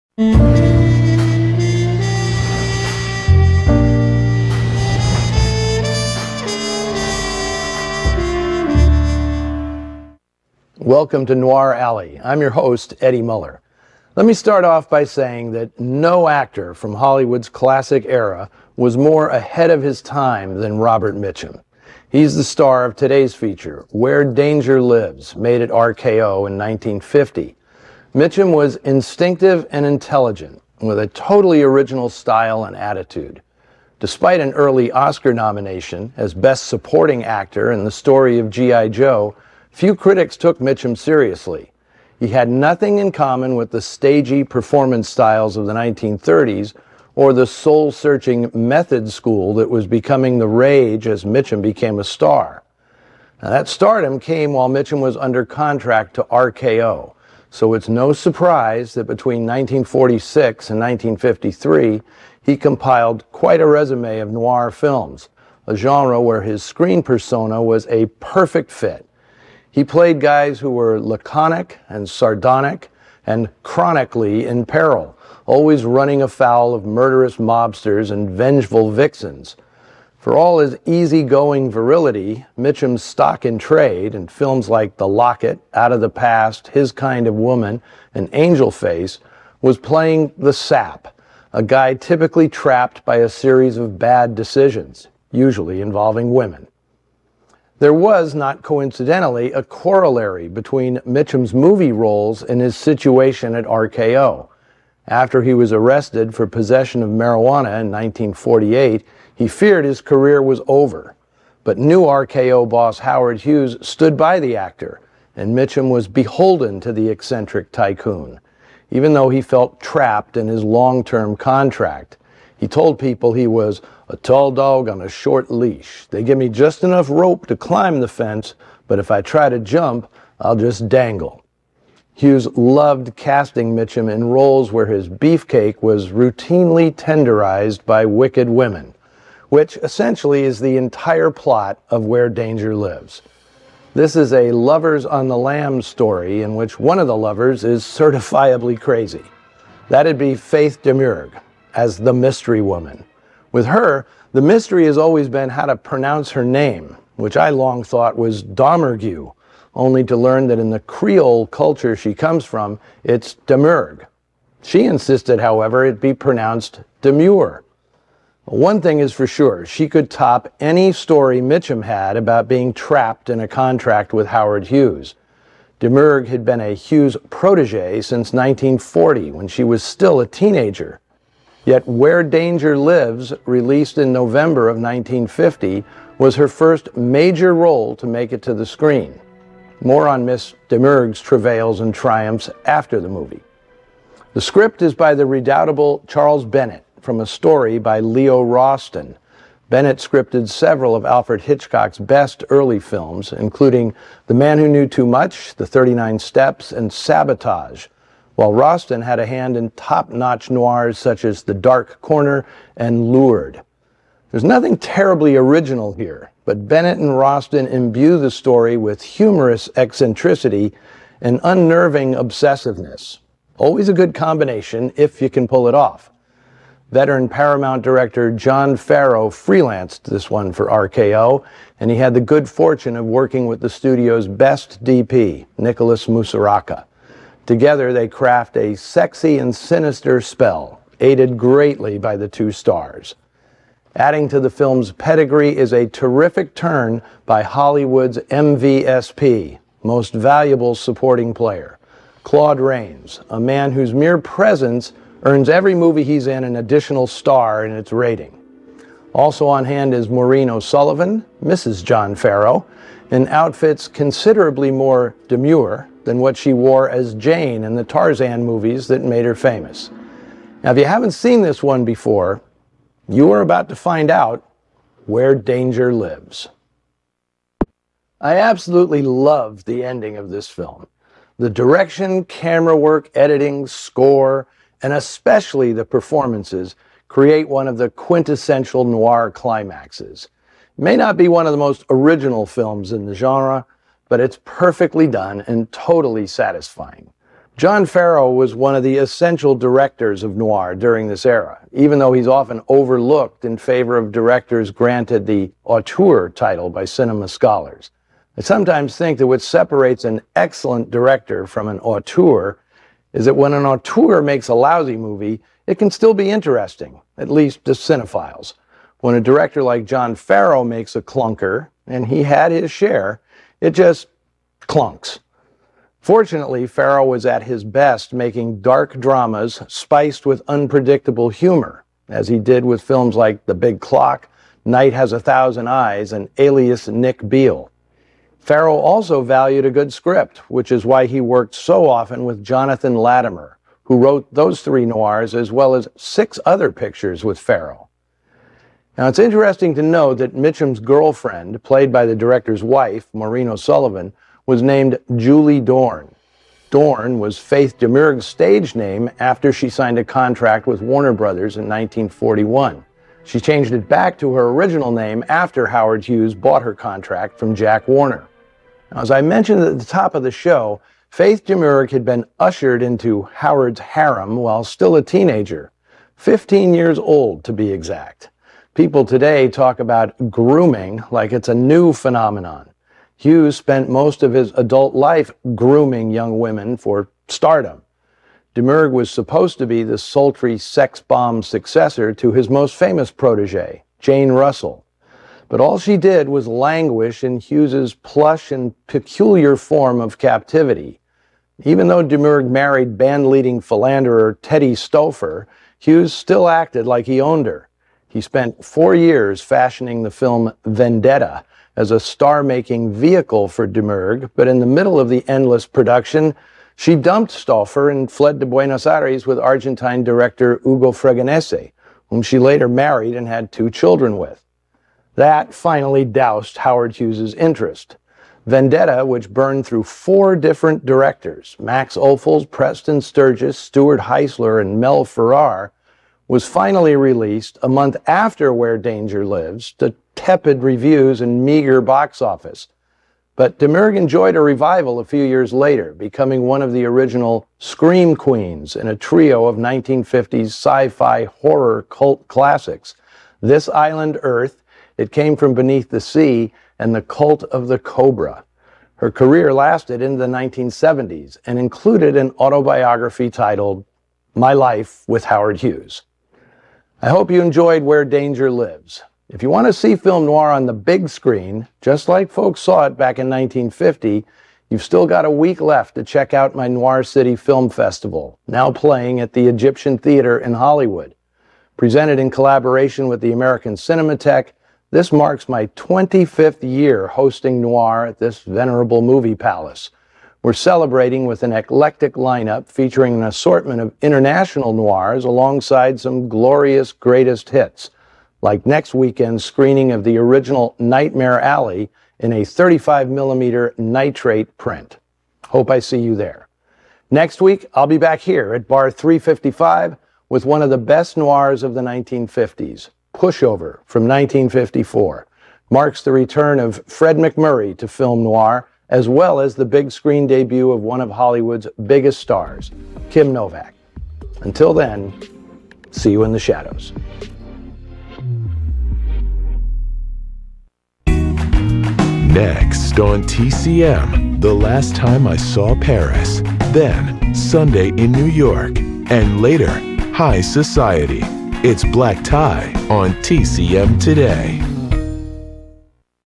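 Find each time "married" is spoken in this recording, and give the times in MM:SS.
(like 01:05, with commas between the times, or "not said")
06:42, 07:02.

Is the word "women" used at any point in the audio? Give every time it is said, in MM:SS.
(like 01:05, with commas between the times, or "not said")
01:36, 02:18, 06:26.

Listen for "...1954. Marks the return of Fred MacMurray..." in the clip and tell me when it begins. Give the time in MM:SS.
08:34.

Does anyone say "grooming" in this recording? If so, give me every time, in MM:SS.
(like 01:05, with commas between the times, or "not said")
06:20, 06:25.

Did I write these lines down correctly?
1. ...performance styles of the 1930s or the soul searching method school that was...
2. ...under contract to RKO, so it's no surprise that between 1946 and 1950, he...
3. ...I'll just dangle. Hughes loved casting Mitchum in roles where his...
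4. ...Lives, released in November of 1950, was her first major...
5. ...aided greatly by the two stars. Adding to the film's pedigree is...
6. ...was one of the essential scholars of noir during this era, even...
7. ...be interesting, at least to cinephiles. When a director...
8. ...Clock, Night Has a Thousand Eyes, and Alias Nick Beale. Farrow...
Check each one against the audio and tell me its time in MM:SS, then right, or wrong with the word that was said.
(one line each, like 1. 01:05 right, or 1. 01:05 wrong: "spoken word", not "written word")
1. 00:44 right
2. 00:55 wrong: "1953", not "1950"
3. 02:10 right
4. 03:02 right
5. 04:00 right
6. 04:58 wrong: "directors", not "scholars"
7. 05:16 right
8. 05:33 right.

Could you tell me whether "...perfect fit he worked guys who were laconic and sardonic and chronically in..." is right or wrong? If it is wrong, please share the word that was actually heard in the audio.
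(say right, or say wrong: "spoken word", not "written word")
wrong: "played", not "worked".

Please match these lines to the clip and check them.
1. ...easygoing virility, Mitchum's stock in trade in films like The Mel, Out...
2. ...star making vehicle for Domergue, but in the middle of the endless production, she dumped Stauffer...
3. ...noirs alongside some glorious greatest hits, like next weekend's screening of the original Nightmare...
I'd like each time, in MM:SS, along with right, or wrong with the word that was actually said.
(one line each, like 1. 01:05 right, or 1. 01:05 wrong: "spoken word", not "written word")
1. 01:20 wrong: "Locket", not "Mel"
2. 06:51 right
3. 08:14 right.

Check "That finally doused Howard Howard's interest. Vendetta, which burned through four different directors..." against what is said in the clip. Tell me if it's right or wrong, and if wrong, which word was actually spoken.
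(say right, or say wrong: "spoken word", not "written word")
wrong: "Hughes", not "Howard".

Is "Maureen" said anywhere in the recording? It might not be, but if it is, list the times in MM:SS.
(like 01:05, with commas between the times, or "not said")
04:20, 05:53.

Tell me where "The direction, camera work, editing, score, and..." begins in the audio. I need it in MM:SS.
04:41.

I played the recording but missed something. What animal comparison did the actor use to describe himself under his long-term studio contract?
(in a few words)
a tall dog on a short leash.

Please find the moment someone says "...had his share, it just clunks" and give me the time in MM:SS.
05:22.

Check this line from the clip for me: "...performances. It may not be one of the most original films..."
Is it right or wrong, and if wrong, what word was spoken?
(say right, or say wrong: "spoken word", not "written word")
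wrong: "climaxes", not "performances".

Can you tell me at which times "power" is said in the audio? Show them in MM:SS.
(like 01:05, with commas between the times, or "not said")
not said.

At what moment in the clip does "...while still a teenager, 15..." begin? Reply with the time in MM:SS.
06:14.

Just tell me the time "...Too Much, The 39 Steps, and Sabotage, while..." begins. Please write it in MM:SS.
03:24.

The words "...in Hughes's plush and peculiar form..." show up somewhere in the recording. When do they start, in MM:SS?
06:37.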